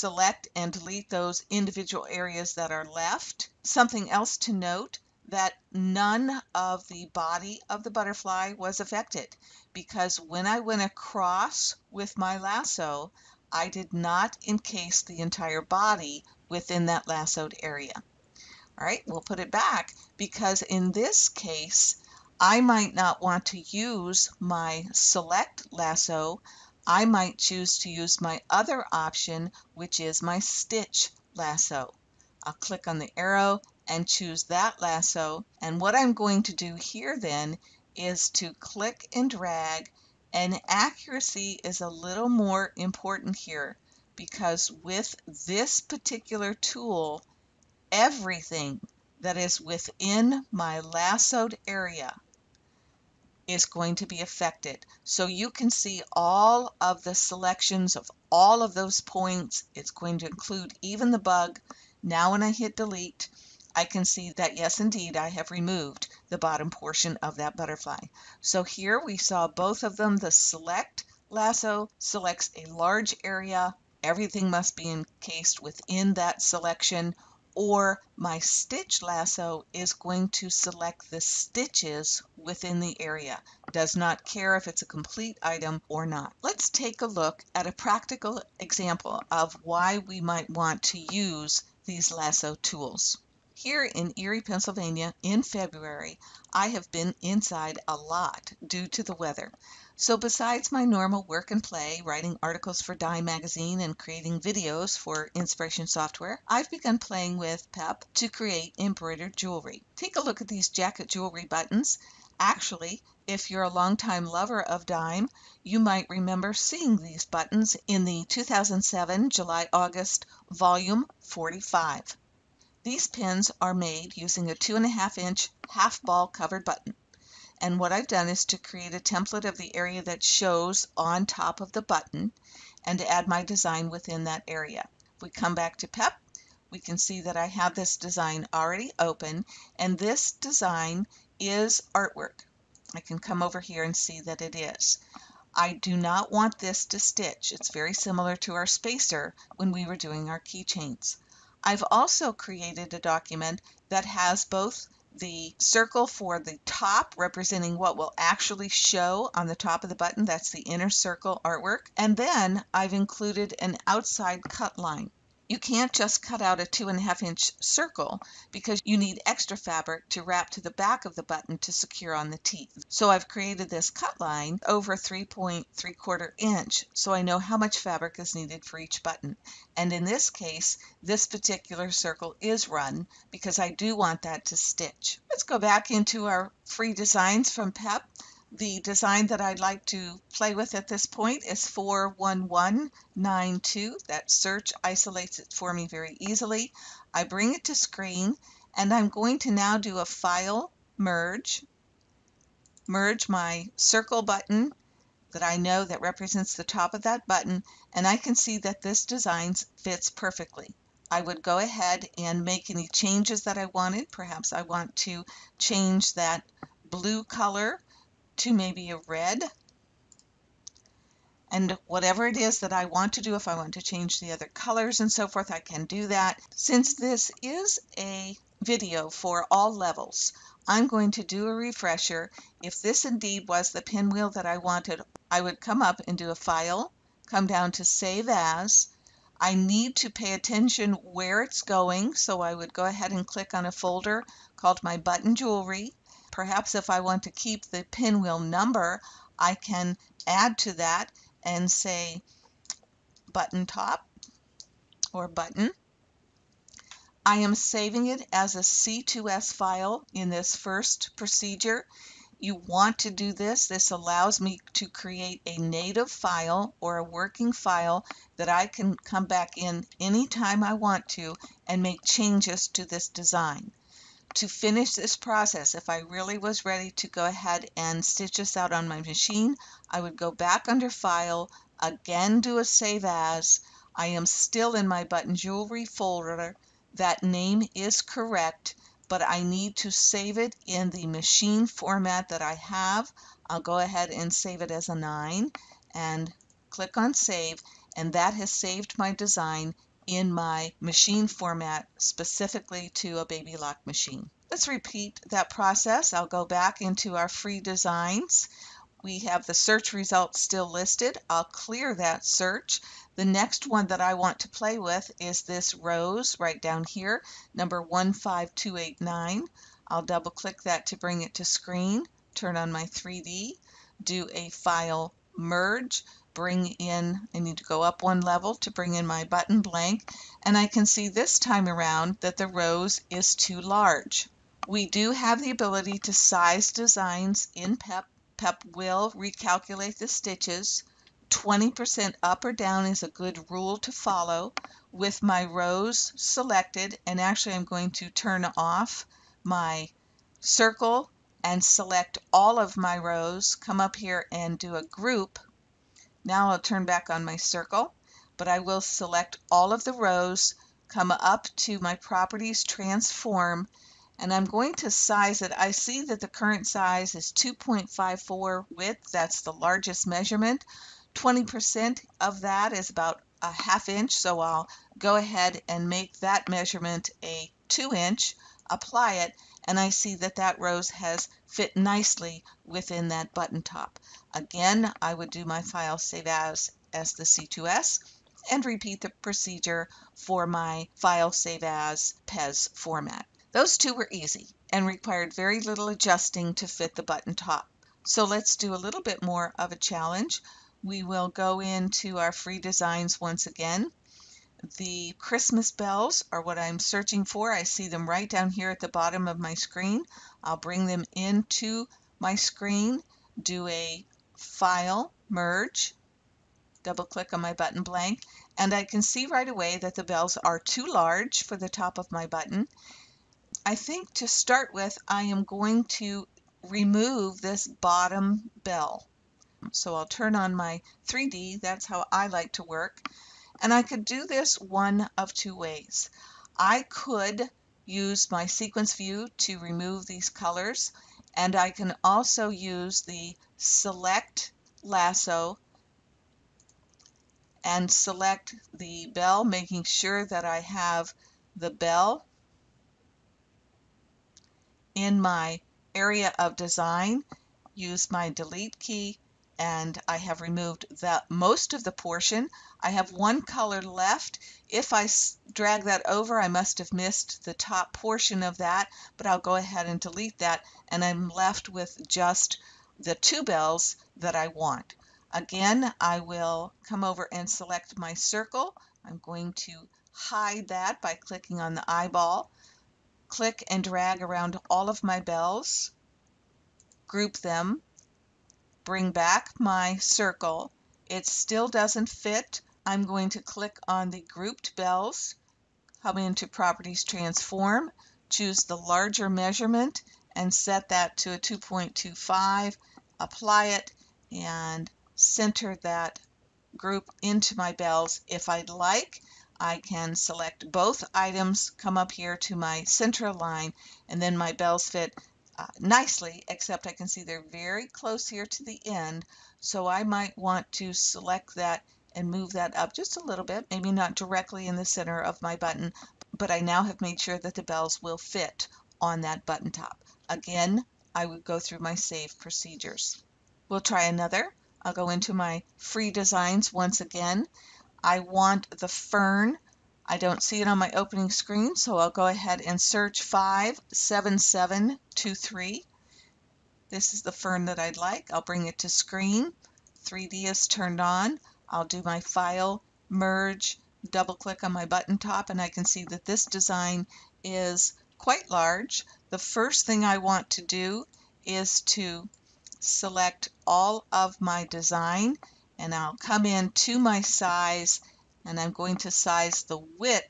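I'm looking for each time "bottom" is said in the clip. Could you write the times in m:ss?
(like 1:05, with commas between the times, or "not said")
1:06, 6:48, 7:07.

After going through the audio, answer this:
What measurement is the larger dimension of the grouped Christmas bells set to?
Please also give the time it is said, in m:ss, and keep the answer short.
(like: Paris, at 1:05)
2.25, at 8:21.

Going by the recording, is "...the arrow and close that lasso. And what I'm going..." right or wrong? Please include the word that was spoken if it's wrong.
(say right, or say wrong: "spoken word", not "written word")
wrong: "choose", not "close".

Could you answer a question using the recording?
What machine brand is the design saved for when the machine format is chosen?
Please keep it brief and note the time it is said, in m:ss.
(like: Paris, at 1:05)
Baby Lock, at 5:03.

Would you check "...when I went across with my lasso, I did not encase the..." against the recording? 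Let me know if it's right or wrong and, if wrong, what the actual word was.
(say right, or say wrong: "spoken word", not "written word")
right.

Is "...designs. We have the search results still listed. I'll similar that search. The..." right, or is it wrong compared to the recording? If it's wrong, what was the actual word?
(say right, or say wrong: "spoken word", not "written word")
wrong: "clear", not "similar".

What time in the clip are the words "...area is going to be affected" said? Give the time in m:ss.
0:51.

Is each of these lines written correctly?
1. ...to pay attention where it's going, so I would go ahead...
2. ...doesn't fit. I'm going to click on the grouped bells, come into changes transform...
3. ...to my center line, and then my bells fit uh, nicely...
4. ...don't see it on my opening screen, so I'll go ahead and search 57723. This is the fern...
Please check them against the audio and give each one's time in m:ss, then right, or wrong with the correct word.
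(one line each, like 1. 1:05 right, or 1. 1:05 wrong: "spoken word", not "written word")
1. 3:59 right
2. 8:11 wrong: "properties", not "changes"
3. 8:32 right
4. 9:00 right.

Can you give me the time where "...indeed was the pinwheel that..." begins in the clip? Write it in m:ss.
3:53.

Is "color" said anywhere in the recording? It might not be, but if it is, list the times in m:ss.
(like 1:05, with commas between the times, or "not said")
3:37, 3:44, 7:20, 7:43.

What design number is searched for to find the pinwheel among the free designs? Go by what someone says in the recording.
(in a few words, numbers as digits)
41192.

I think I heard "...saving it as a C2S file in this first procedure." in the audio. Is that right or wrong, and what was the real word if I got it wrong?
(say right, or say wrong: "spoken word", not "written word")
right.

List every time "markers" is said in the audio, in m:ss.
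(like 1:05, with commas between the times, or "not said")
not said.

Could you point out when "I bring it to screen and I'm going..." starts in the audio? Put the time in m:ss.
3:17.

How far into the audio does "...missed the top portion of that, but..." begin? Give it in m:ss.
7:46.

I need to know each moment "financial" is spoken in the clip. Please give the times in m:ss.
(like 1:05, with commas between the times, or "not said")
not said.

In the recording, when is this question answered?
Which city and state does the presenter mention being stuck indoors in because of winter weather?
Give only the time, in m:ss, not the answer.
1:34.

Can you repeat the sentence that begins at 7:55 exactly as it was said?
Again, I will come over and select my circle.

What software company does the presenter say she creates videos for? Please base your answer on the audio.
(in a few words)
Inspiration Software.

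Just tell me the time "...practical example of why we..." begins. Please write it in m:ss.
1:27.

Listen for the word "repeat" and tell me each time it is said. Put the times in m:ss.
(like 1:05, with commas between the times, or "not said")
5:04, 6:28.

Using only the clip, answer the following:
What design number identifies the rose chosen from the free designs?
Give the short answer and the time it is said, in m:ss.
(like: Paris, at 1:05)
15289, at 5:17.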